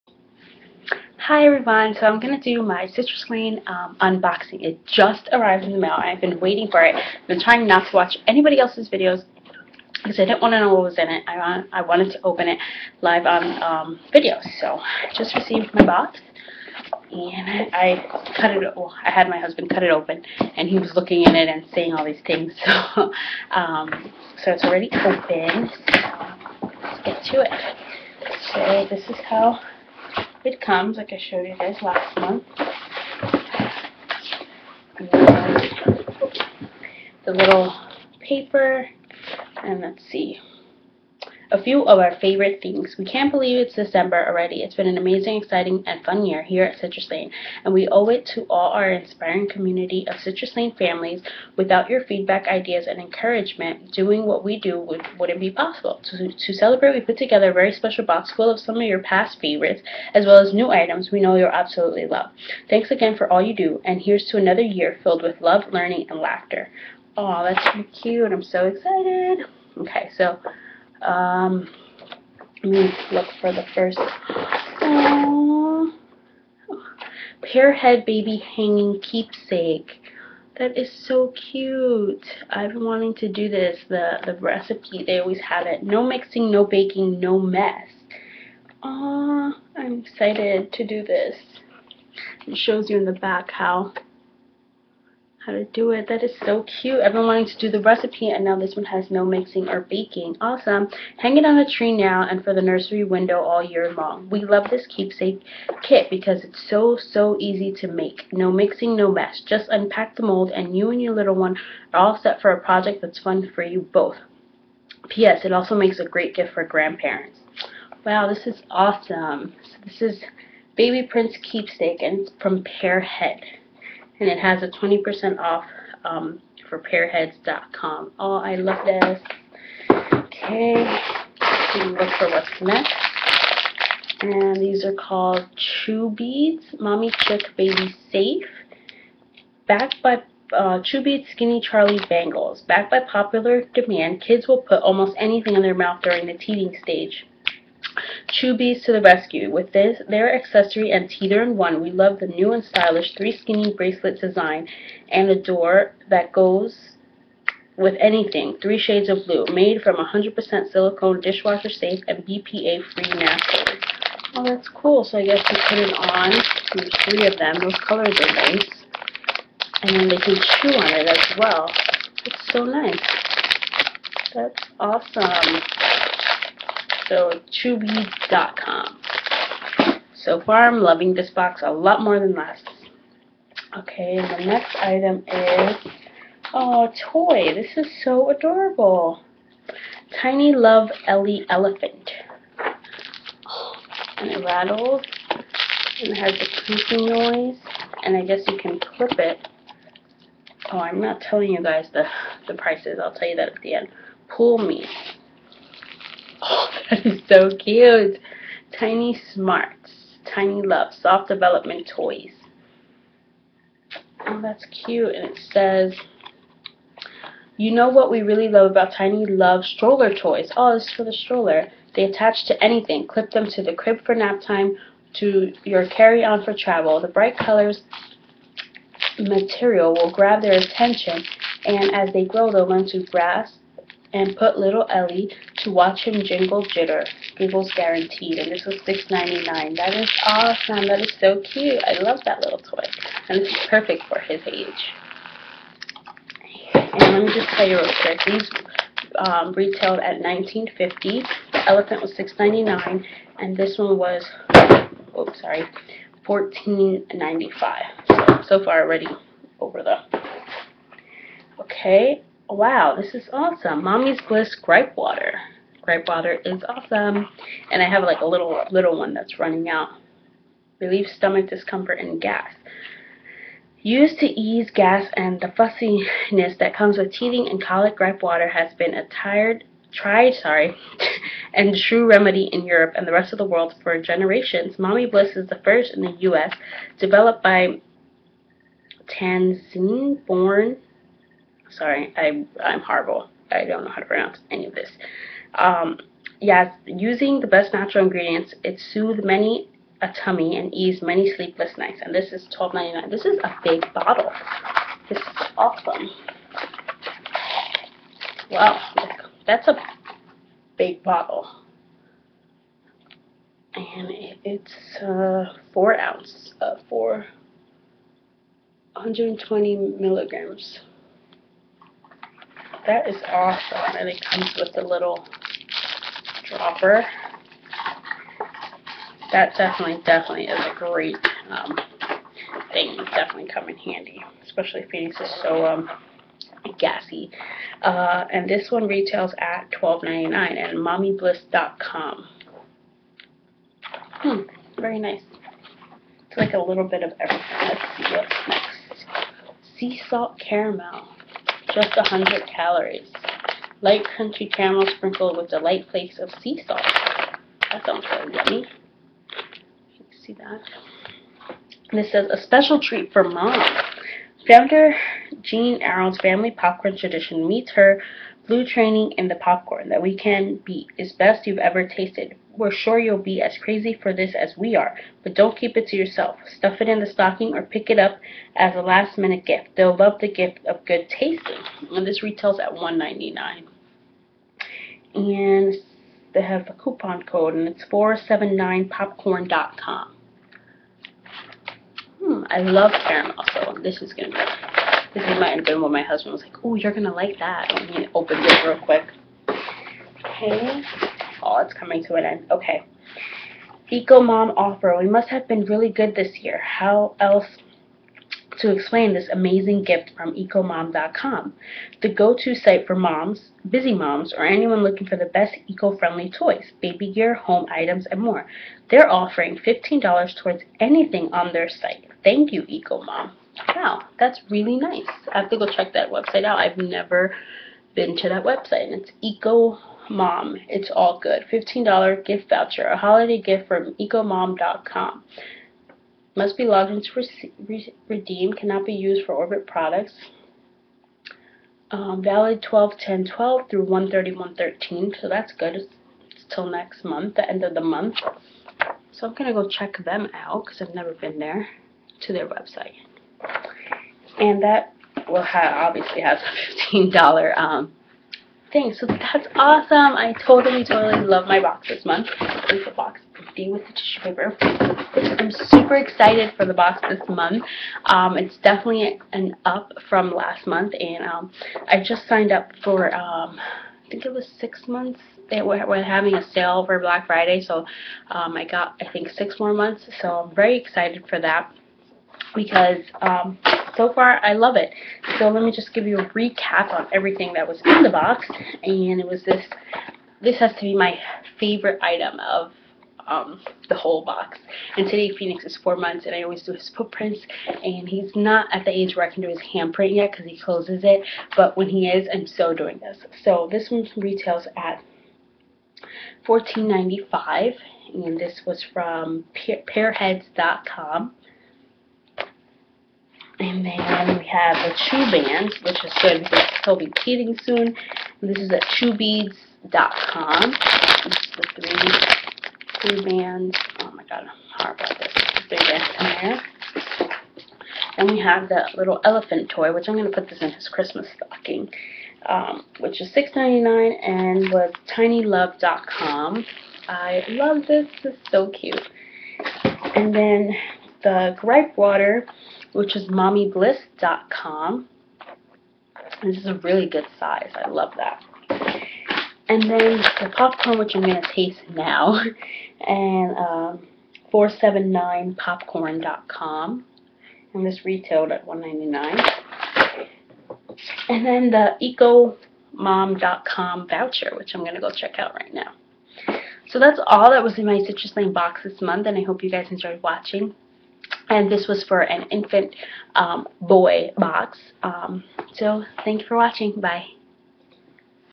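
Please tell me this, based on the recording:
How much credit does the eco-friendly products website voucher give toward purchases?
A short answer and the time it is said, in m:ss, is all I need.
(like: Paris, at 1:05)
$15, at 6:59.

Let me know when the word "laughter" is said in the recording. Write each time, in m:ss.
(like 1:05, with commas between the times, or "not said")
1:06.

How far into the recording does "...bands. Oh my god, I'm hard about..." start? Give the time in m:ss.
8:43.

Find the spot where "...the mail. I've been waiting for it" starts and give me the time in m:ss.
0:05.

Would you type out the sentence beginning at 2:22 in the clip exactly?
Backed by popular demand, kids will put almost anything in their mouth during the teething stage.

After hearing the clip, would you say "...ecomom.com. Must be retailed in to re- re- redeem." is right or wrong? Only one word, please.
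wrong.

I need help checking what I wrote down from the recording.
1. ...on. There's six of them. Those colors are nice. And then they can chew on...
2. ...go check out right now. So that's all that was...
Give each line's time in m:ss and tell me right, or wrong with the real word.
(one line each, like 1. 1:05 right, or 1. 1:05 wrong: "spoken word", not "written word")
1. 2:45 wrong: "three", not "six"
2. 9:24 right.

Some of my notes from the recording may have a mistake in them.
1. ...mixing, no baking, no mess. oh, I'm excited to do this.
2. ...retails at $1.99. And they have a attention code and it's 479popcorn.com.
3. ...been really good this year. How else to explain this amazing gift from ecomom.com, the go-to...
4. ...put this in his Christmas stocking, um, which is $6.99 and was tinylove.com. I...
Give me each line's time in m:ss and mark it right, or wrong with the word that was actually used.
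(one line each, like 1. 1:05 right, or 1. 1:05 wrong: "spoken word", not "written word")
1. 1:26 right
2. 6:22 wrong: "coupon", not "attention"
3. 6:45 right
4. 8:50 right.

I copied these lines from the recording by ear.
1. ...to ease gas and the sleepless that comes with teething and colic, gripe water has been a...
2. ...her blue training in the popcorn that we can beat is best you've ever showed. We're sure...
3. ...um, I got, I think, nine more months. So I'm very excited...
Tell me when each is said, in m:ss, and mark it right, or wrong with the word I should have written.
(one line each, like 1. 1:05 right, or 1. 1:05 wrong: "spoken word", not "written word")
1. 4:34 wrong: "fussiness", not "sleepless"
2. 6:07 wrong: "tasted", not "showed"
3. 7:58 wrong: "six", not "nine".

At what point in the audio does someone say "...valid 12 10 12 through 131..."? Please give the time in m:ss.
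7:22.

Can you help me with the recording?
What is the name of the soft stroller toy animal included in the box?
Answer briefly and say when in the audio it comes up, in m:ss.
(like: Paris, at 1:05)
Ellie Elephant, at 3:11.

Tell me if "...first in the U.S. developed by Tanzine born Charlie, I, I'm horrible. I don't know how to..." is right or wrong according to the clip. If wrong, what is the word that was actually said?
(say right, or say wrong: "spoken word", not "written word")
wrong: "Sorry", not "Charlie".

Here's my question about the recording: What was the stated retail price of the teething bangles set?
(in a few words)
$19.50.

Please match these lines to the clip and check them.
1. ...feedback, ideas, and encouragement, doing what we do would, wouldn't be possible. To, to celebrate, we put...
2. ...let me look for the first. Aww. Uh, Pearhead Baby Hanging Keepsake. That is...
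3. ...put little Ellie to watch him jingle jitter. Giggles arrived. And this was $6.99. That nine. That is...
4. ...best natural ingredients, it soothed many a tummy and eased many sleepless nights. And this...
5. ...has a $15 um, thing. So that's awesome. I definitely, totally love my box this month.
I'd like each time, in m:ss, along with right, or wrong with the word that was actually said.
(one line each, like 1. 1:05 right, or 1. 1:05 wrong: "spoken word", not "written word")
1. 0:52 right
2. 1:12 right
3. 3:54 wrong: "guaranteed", not "arrived"
4. 4:57 right
5. 7:36 wrong: "totally", not "definitely".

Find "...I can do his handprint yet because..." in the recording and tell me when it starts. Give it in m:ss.
8:19.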